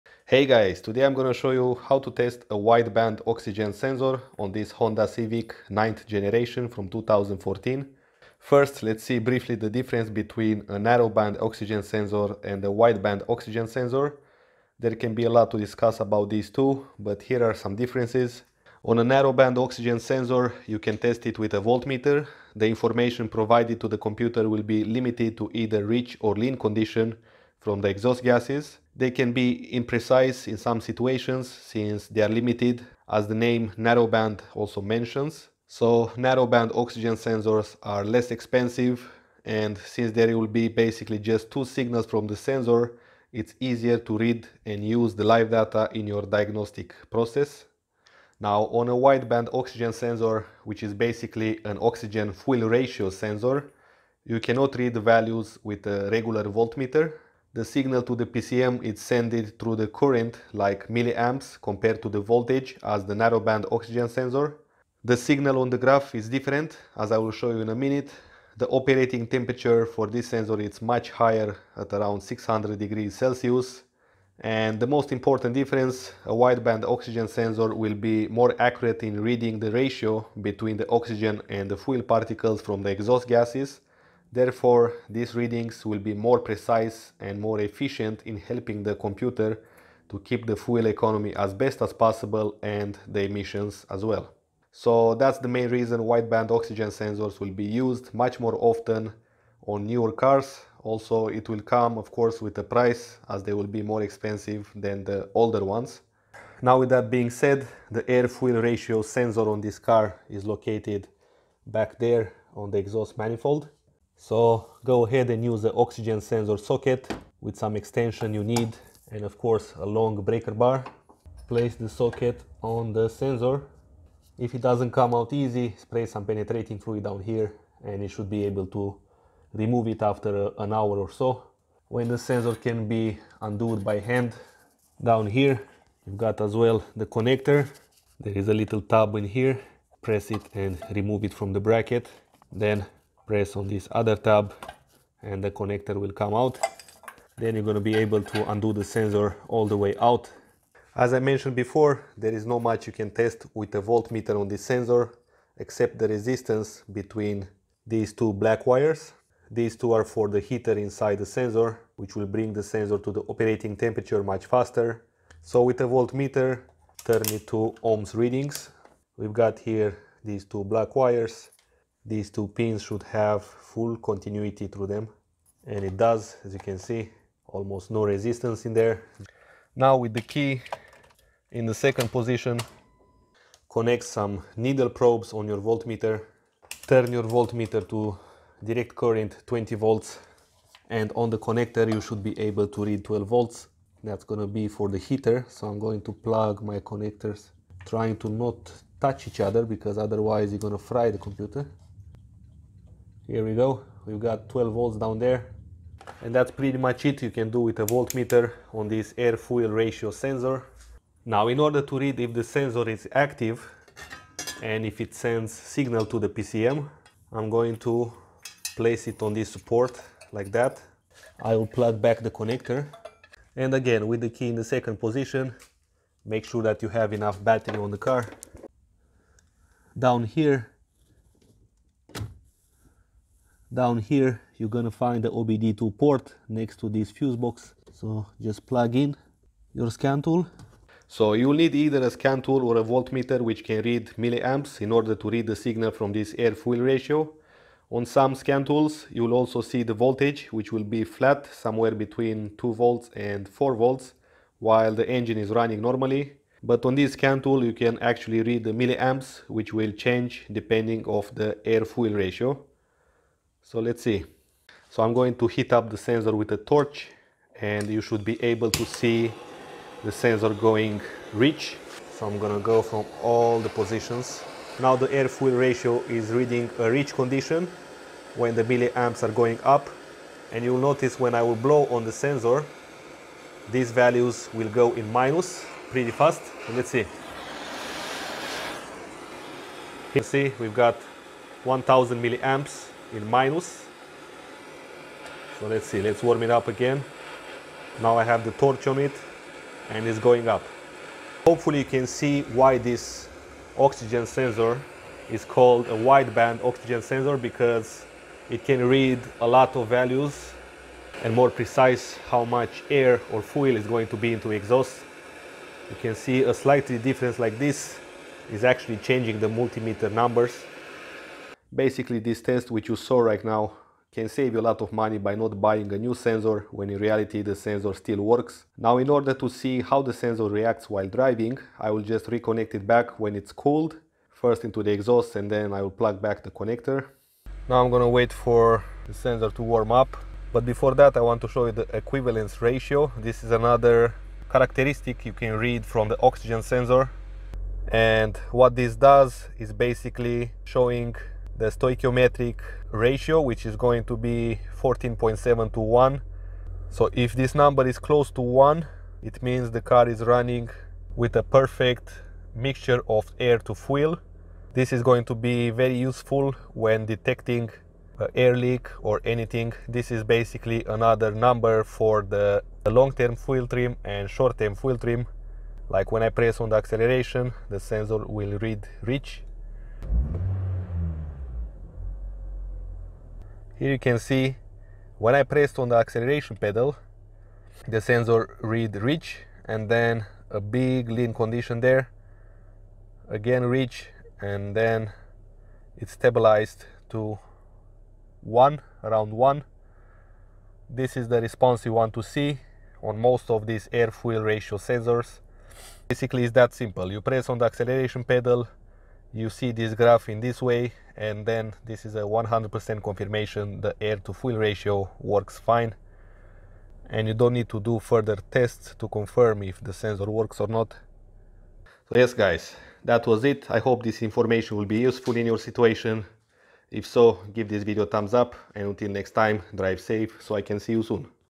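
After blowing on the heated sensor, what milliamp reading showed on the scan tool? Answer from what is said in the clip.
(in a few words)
1000 milliamps.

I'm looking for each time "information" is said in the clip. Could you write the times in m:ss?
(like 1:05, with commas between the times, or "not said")
0:22, 7:04.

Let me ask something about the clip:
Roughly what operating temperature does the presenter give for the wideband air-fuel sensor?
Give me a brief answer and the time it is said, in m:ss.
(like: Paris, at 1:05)
600 degrees Celsius, at 1:12.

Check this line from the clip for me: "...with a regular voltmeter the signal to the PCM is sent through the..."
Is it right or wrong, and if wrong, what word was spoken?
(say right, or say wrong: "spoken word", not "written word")
right.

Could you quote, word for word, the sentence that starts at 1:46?
Now, with that being said, the air-fuel ratio sensor on this car is located back there on the exhaust manifold.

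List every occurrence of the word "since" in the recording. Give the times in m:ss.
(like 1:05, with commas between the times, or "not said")
0:31, 0:39.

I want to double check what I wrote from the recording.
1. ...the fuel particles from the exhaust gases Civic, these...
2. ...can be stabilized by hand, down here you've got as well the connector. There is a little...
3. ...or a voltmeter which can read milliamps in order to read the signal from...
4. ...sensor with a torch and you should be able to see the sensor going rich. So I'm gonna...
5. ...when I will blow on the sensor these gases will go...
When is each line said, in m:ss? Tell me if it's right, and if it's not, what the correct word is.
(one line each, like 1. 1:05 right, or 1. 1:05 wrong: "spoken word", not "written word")
1. 1:21 wrong: "Therefore", not "Civic"
2. 2:12 wrong: "undoed", not "stabilized"
3. 4:02 right
4. 4:25 right
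5. 4:41 wrong: "values", not "gases".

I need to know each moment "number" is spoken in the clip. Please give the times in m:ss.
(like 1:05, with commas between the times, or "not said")
5:20, 5:57, 6:11.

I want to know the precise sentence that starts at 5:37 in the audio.
Now I'm gonna wait for the sensor to warm up, but before that I want to show you the equivalence ratio.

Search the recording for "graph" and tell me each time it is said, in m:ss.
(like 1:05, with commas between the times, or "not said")
1:05, 6:49.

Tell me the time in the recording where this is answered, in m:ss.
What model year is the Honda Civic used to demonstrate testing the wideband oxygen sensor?
0:06.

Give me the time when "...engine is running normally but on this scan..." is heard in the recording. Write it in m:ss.
4:15.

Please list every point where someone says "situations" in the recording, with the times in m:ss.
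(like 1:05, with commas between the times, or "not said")
0:30, 7:05.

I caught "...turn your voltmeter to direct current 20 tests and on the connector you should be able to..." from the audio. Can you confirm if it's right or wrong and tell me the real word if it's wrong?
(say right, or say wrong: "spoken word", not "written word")
wrong: "volts", not "tests".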